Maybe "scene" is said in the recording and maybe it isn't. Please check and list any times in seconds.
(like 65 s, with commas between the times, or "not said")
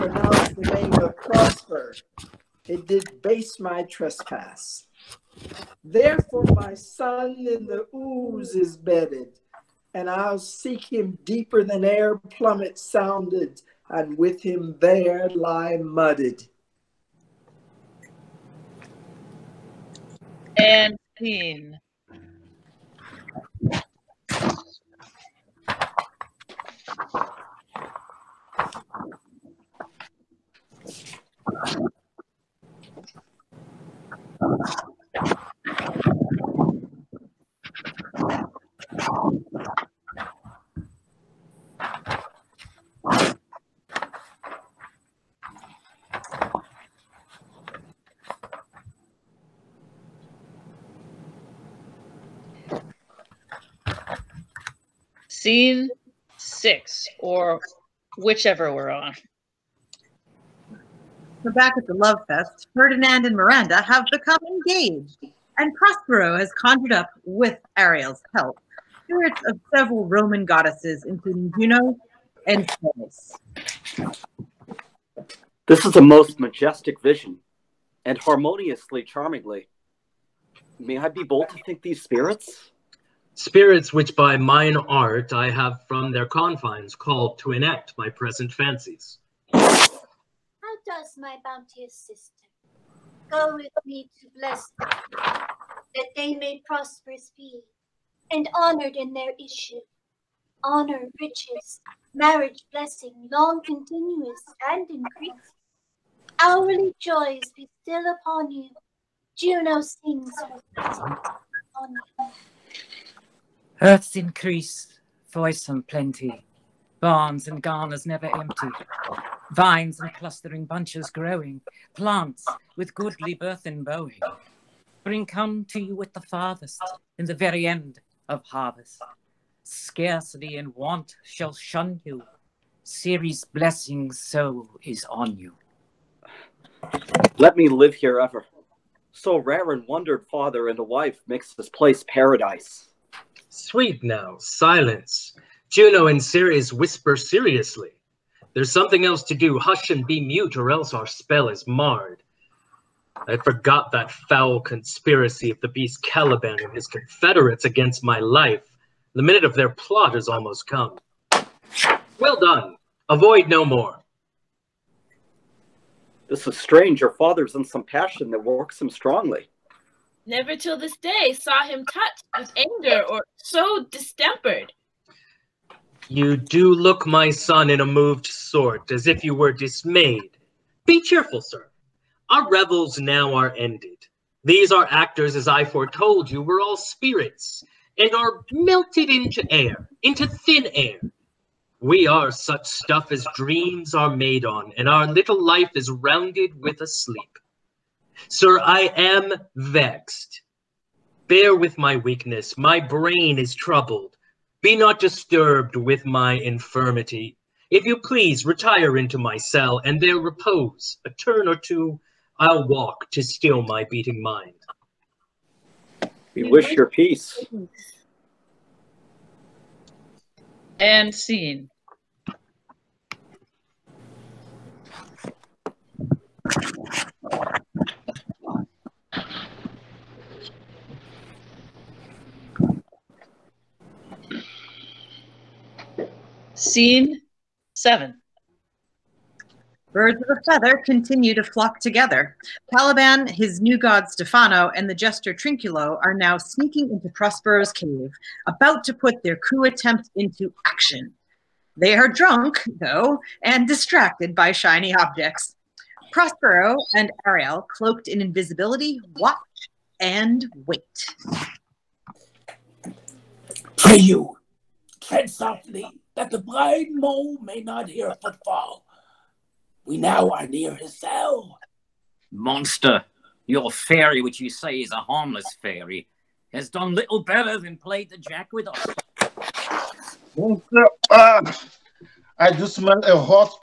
21 s, 55 s, 221 s, 236 s.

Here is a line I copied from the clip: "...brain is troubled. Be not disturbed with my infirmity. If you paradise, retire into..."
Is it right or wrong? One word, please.
wrong.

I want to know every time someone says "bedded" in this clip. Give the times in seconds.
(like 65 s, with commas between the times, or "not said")
8 s.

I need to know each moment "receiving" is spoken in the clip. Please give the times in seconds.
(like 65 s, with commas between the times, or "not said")
not said.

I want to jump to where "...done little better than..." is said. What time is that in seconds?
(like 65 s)
276 s.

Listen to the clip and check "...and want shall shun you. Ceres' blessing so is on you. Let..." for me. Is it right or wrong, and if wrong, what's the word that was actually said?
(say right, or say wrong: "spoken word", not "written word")
right.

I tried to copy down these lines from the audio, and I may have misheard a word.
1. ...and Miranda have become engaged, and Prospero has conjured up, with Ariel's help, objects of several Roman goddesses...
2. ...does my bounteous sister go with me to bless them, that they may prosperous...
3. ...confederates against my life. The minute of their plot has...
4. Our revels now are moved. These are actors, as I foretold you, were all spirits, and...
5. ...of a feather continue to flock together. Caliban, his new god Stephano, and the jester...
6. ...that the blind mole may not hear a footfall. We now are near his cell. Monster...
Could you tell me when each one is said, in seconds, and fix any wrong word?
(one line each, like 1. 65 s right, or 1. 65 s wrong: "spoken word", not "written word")
1. 63 s wrong: "spirits", not "objects"
2. 90 s right
3. 156 s right
4. 182 s wrong: "ended", not "moved"
5. 240 s right
6. 266 s right.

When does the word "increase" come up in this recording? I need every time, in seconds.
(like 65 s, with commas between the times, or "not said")
104 s, 114 s.